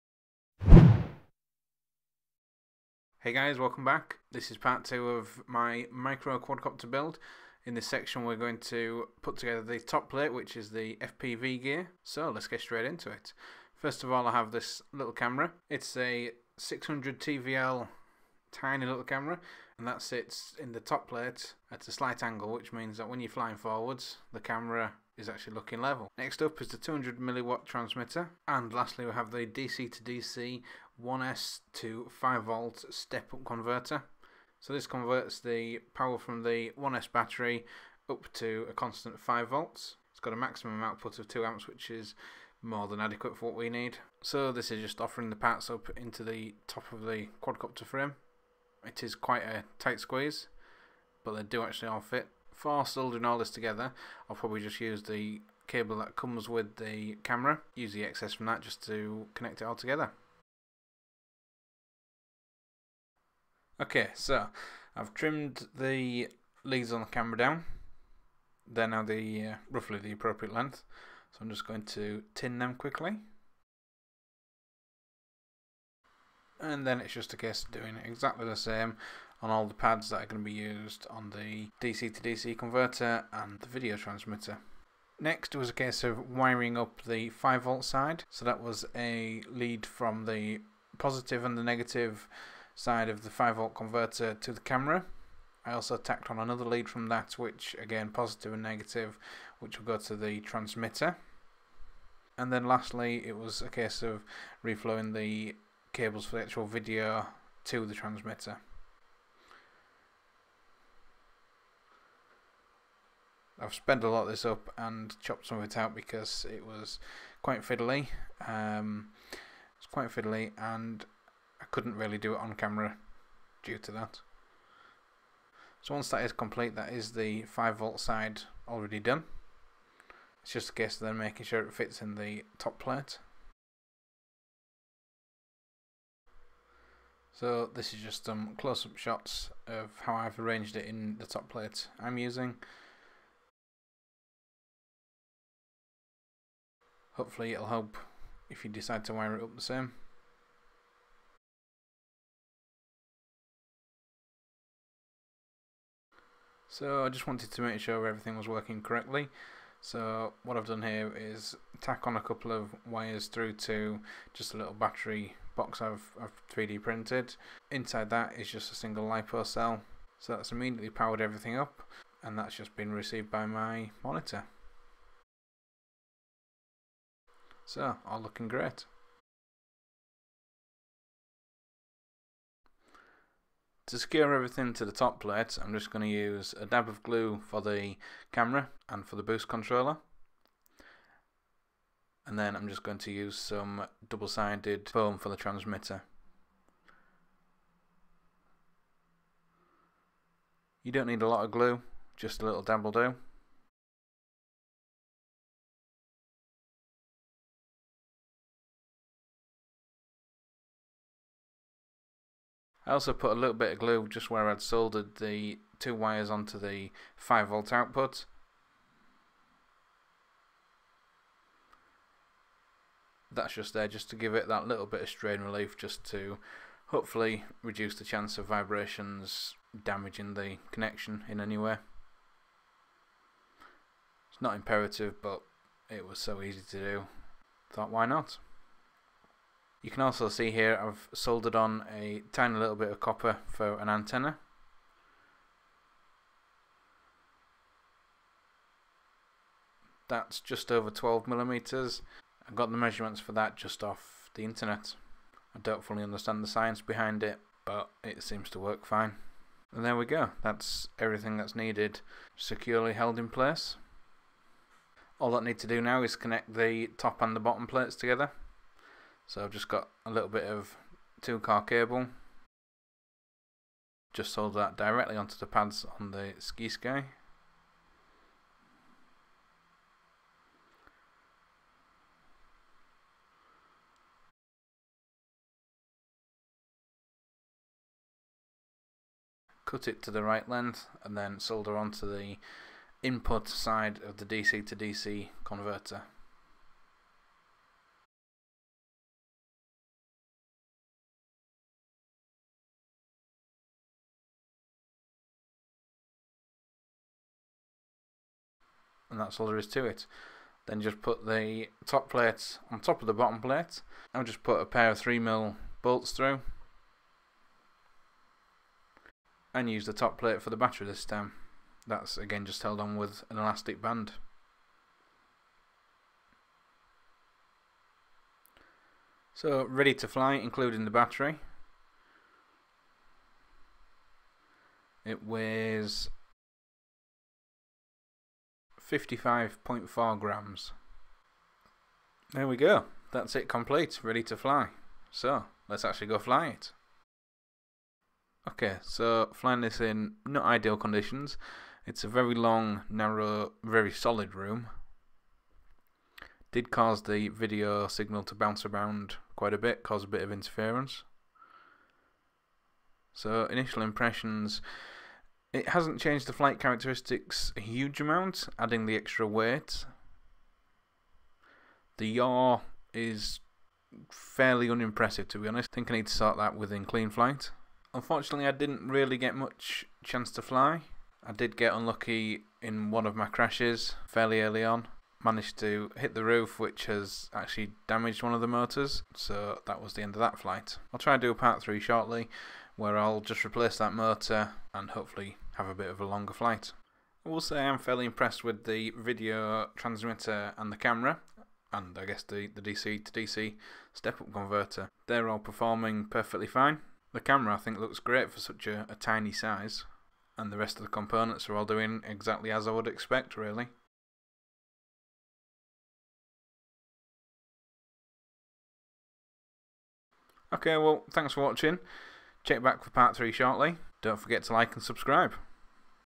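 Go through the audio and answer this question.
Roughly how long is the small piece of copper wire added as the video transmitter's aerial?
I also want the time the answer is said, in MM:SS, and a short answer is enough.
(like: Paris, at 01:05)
just over 12 millimeters, at 04:10.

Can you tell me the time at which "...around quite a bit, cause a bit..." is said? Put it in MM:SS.
05:58.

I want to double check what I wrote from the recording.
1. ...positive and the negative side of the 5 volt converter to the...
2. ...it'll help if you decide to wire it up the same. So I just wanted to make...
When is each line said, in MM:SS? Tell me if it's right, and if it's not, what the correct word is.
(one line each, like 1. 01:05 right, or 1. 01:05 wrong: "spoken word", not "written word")
1. 01:30 right
2. 02:27 right.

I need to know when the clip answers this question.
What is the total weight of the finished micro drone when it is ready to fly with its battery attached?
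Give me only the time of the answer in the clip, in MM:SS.
05:38.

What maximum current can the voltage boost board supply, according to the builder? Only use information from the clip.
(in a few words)
2 amps.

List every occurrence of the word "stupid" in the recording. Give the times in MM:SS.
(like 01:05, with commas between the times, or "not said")
not said.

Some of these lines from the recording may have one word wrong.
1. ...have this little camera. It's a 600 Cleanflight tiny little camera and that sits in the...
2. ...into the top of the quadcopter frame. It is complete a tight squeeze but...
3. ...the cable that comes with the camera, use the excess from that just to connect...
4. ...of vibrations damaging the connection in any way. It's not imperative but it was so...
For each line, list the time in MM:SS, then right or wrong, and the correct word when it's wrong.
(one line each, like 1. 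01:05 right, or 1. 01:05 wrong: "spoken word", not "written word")
1. 00:14 wrong: "TVL", not "Cleanflight"
2. 00:45 wrong: "quite", not "complete"
3. 00:55 right
4. 03:48 right.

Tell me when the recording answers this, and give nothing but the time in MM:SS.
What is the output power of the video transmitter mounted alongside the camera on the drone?
00:26.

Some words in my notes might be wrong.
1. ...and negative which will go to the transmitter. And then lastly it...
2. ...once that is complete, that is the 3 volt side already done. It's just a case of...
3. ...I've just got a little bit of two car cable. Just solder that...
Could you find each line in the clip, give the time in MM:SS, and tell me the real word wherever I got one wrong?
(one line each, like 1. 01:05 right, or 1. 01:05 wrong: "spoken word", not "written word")
1. 01:38 right
2. 02:05 wrong: "5", not "3"
3. 04:29 right.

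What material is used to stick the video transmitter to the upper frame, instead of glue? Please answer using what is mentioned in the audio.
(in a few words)
double-sided foam.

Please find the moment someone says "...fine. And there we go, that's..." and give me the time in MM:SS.
04:18.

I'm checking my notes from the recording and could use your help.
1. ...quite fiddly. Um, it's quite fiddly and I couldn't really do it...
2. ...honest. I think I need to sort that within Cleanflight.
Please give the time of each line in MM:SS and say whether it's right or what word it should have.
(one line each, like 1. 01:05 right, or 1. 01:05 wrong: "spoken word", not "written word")
1. 01:57 right
2. 06:15 right.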